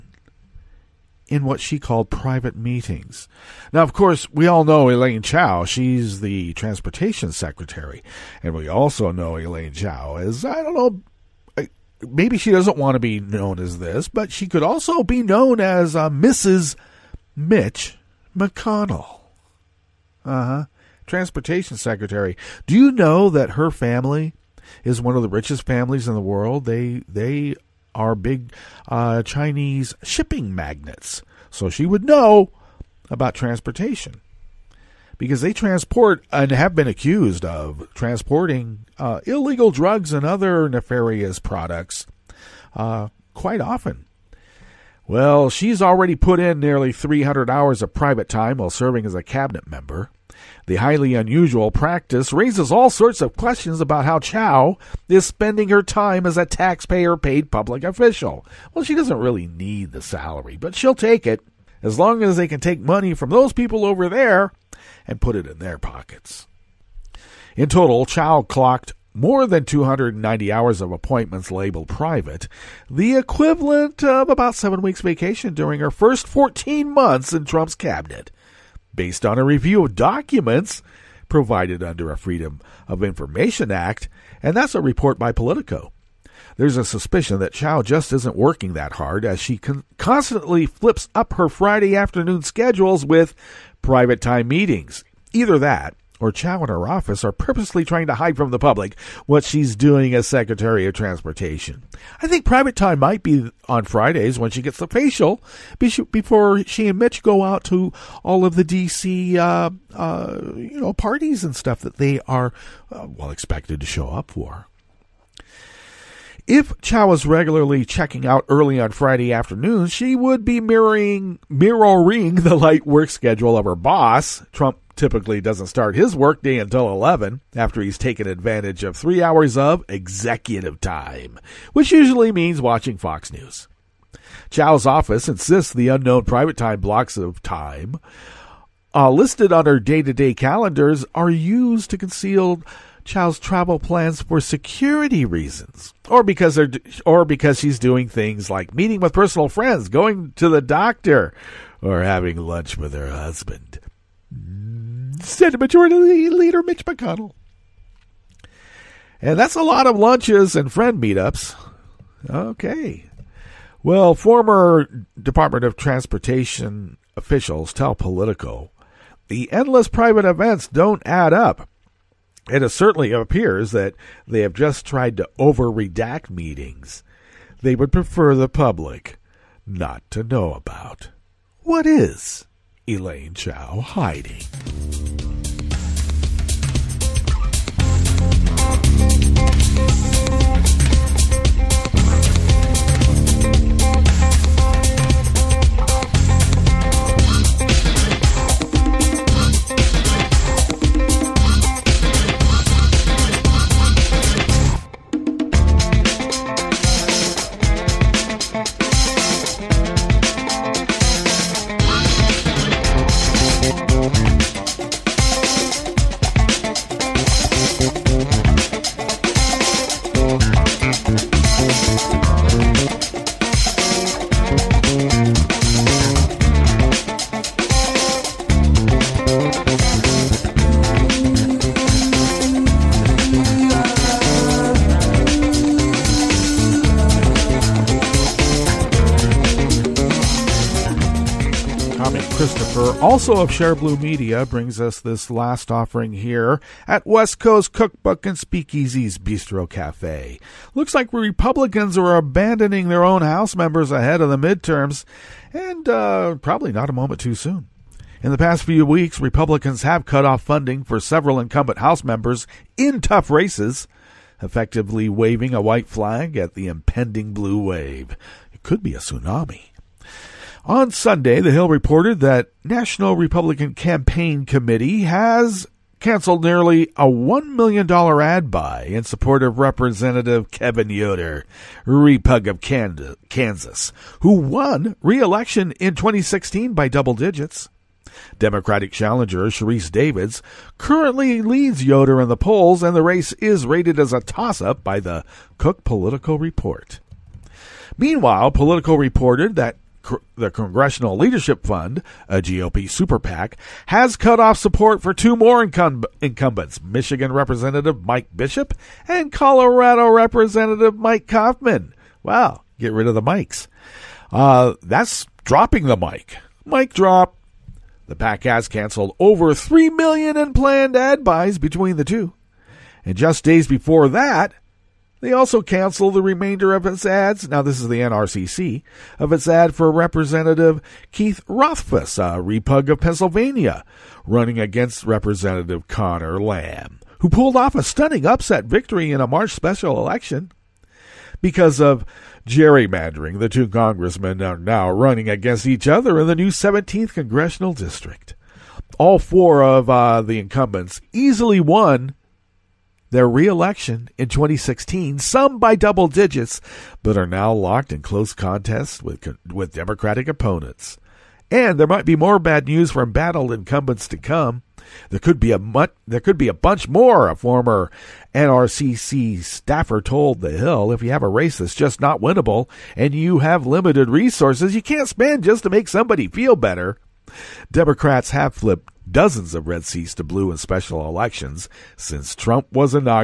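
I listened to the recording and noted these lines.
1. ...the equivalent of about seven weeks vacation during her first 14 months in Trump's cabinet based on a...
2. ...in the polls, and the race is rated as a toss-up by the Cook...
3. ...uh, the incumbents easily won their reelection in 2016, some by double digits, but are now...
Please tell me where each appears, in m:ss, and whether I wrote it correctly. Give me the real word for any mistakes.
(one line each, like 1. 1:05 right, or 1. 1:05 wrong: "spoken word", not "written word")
1. 1:12 right
2. 4:52 right
3. 5:49 right.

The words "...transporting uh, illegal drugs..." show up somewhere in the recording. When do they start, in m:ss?
0:37.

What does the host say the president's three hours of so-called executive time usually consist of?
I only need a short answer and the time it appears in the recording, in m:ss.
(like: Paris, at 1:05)
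Watching Fox News, at 2:12.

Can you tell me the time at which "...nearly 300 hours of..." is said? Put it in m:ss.
0:46.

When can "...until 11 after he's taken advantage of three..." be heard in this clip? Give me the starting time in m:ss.
2:06.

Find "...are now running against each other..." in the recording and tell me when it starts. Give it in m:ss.
5:44.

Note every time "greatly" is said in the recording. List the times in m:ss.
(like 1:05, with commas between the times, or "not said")
not said.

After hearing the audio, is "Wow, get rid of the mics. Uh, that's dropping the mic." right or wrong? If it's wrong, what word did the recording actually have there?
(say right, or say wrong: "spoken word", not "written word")
right.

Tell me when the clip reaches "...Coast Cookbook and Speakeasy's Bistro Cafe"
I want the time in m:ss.
4:07.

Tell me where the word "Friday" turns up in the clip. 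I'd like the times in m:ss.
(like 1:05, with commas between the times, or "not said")
1:31, 1:43, 1:58.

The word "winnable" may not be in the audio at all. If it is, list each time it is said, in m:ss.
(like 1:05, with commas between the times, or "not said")
6:12.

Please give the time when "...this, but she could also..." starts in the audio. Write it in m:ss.
0:13.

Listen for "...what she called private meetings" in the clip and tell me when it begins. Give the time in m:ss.
0:01.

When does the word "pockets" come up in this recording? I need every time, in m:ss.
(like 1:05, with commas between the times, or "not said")
1:05.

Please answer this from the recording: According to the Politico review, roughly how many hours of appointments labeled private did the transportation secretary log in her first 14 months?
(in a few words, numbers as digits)
290.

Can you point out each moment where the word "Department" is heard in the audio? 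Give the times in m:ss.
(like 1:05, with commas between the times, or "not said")
2:45.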